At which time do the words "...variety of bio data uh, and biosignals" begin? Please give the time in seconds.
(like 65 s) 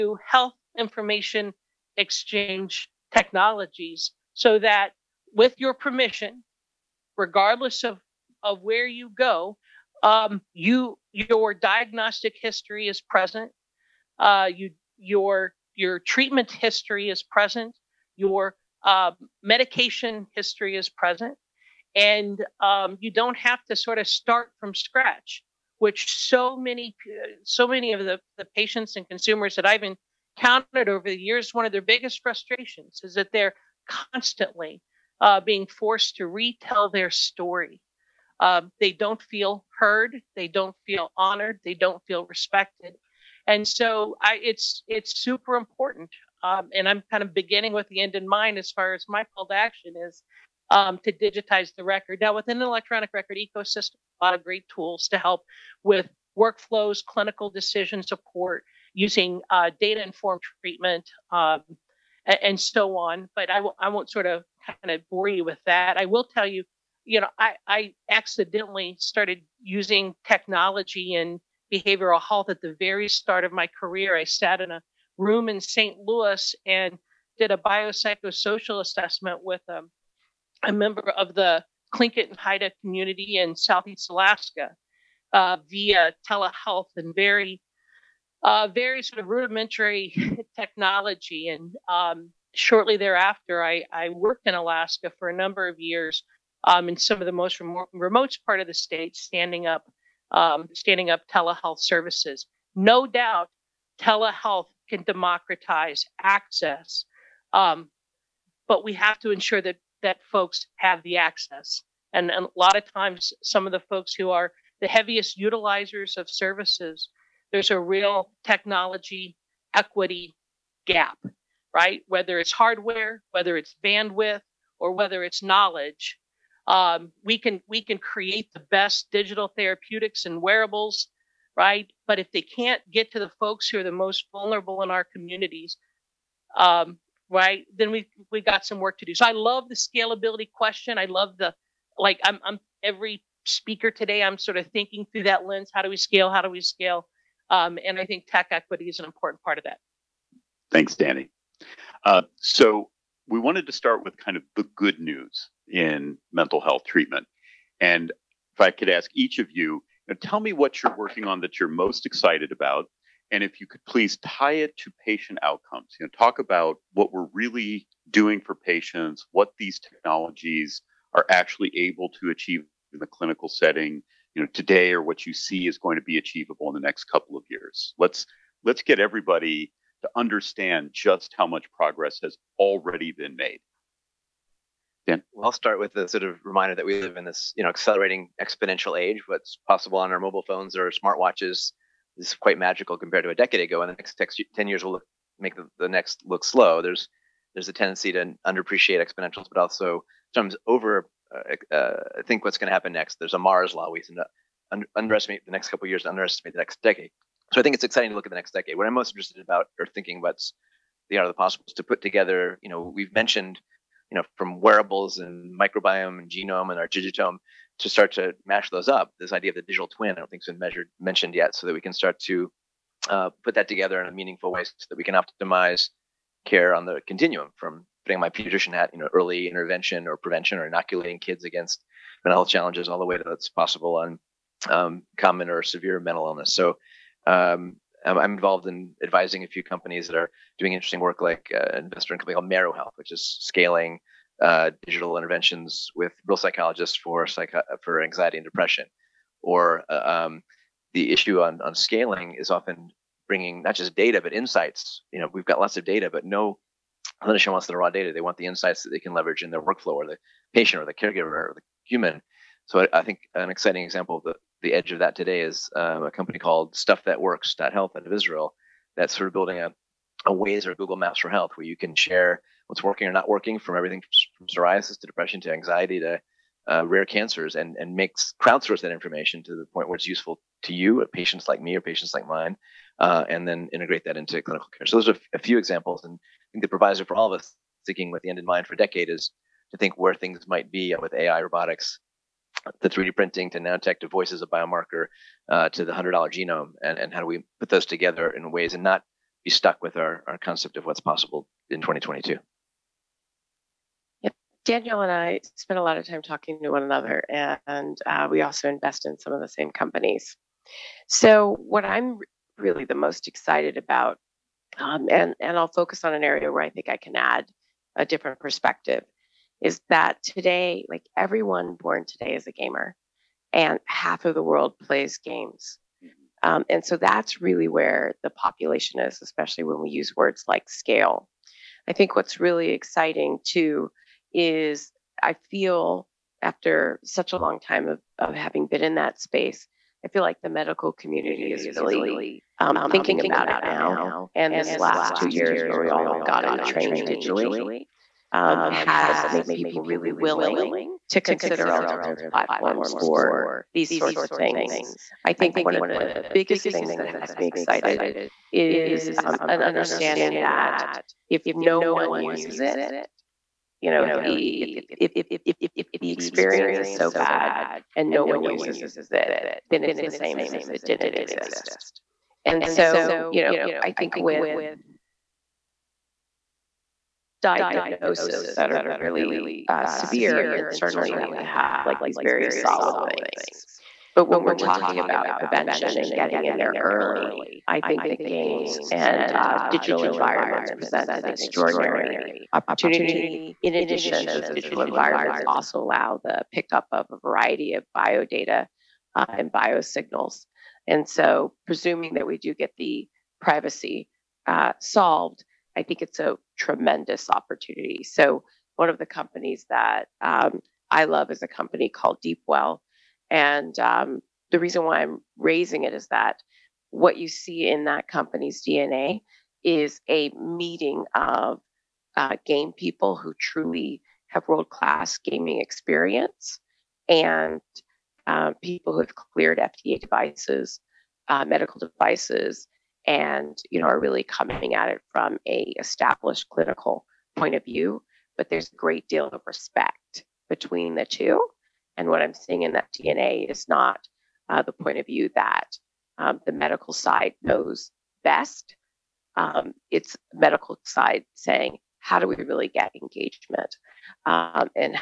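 397 s.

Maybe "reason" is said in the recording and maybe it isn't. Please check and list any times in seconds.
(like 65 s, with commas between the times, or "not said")
414 s.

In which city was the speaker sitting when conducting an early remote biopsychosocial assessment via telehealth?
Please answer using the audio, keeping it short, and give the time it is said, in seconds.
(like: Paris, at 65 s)
St. Louis, at 75 s.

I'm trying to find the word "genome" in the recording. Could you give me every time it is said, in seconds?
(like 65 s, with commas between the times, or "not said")
216 s, 296 s.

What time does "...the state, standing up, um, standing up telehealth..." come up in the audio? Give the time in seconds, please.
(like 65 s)
98 s.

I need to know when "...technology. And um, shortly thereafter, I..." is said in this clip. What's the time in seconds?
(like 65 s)
90 s.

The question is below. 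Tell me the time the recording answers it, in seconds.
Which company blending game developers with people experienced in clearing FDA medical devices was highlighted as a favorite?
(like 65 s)
412 s.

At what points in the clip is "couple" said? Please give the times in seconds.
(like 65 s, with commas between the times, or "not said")
177 s, 205 s.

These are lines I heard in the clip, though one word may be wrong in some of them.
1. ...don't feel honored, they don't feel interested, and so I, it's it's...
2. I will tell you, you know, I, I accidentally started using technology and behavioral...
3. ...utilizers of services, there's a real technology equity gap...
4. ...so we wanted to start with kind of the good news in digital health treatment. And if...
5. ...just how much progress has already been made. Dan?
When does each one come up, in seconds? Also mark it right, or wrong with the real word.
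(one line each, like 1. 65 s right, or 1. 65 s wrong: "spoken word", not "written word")
1. 40 s wrong: "respected", not "interested"
2. 65 s right
3. 115 s right
4. 152 s wrong: "mental", not "digital"
5. 180 s right.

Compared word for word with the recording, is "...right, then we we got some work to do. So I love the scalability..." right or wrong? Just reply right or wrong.
right.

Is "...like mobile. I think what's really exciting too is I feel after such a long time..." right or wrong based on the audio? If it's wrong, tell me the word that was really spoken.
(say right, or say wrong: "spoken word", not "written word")
wrong: "scale", not "mobile".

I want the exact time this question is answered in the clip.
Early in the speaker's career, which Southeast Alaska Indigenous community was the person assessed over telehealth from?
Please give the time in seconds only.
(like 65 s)
81 s.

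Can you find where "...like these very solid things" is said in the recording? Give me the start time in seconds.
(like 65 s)
381 s.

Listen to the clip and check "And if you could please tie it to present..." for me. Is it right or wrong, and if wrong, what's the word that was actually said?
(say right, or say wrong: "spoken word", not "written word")
wrong: "patient", not "present".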